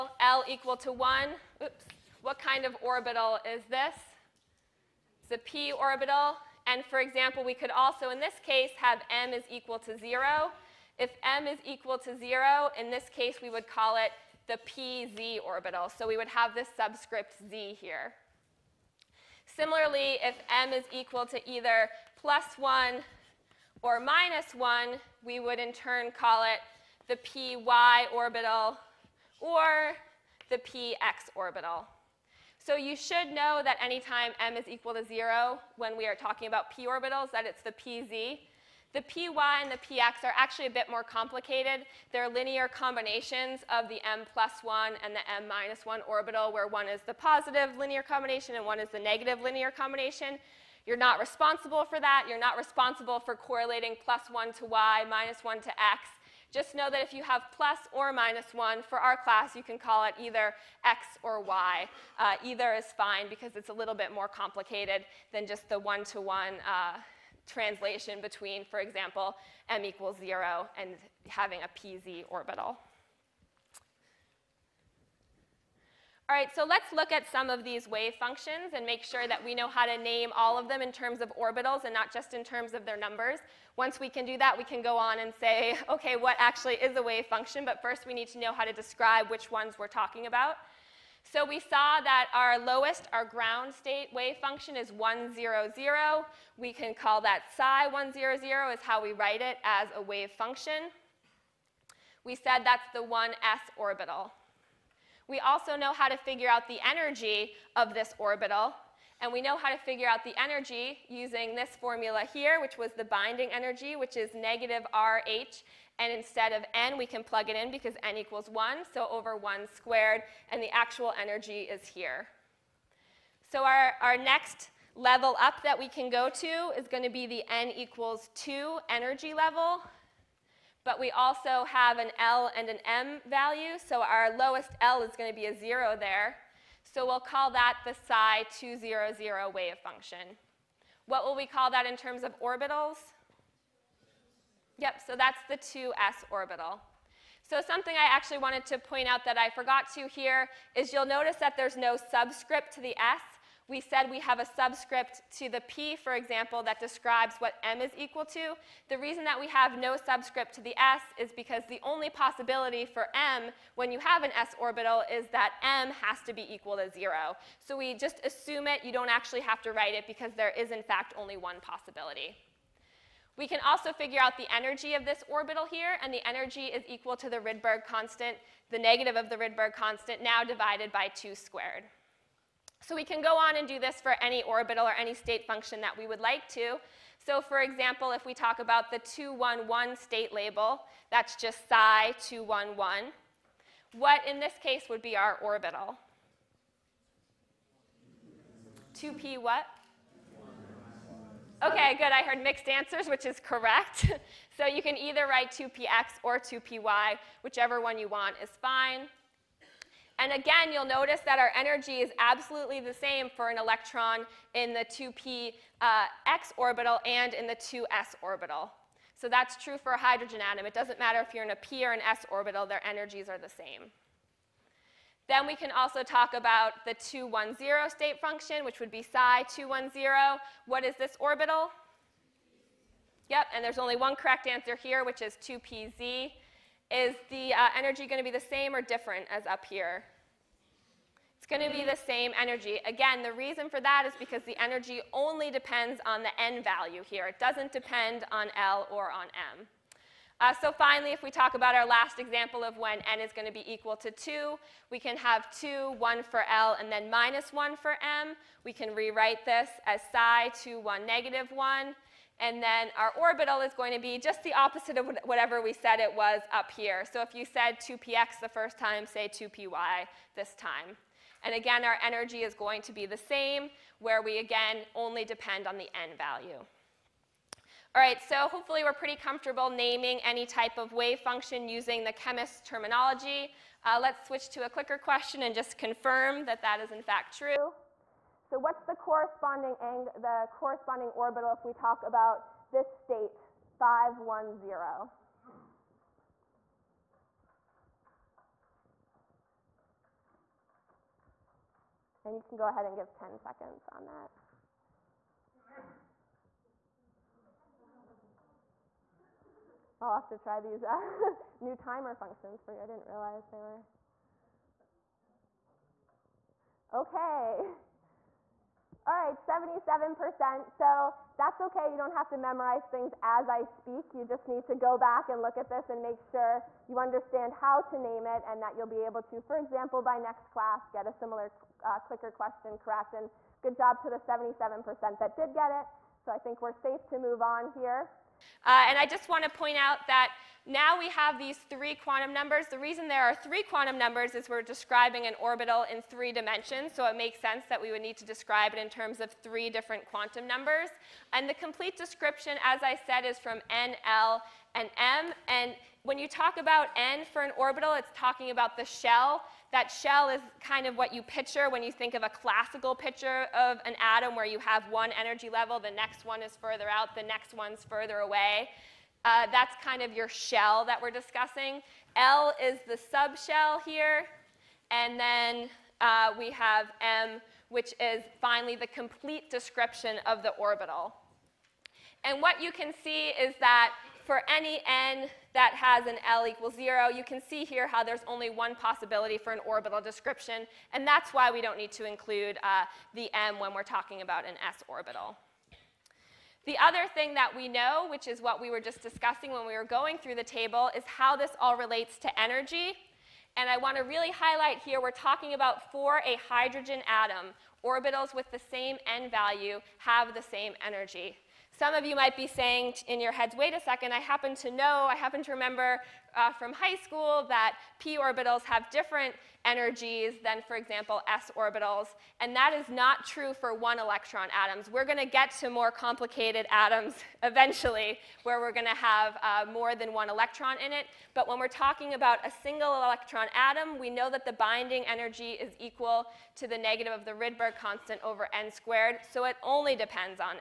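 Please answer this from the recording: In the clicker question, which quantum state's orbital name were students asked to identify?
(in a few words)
5, 1, 0.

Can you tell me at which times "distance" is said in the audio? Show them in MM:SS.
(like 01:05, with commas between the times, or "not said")
not said.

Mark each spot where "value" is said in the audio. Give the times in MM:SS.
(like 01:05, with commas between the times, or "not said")
02:13, 04:06, 04:36, 06:49.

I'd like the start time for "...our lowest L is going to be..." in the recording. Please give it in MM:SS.
02:14.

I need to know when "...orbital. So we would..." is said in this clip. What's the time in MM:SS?
00:15.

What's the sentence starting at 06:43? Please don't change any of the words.
And I want to really highlight here, we're talking about for a hydrogen atom.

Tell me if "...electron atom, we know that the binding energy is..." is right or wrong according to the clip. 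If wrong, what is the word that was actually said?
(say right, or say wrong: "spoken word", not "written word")
right.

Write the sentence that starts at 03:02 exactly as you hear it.
So we can go on and do this for any orbital or any state function that we would like to.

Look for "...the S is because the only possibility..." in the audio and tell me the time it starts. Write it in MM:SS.
02:40.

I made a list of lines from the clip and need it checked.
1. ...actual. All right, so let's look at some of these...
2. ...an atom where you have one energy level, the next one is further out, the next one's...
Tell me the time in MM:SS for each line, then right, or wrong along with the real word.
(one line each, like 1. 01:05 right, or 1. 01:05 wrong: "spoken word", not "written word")
1. 01:12 wrong: "orbital", not "actual"
2. 06:03 right.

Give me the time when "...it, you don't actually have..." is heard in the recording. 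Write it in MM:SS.
02:48.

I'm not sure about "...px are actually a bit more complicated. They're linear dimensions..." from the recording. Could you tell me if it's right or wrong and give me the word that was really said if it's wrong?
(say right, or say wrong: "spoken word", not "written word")
wrong: "combinations", not "dimensions".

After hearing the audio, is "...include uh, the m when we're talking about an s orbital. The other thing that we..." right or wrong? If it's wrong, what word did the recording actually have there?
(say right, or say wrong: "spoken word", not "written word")
right.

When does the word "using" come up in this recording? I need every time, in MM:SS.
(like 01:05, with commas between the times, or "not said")
01:51, 04:41.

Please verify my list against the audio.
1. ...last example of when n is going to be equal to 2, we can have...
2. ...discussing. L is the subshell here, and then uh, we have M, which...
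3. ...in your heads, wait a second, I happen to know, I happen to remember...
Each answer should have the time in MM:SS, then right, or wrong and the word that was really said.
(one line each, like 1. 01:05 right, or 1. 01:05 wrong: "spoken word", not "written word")
1. 04:11 right
2. 06:11 right
3. 06:53 right.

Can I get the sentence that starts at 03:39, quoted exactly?
So that's true for a hydrogen atom.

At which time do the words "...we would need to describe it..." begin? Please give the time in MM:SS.
05:47.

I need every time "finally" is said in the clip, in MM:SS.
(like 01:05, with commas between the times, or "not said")
04:10, 06:18.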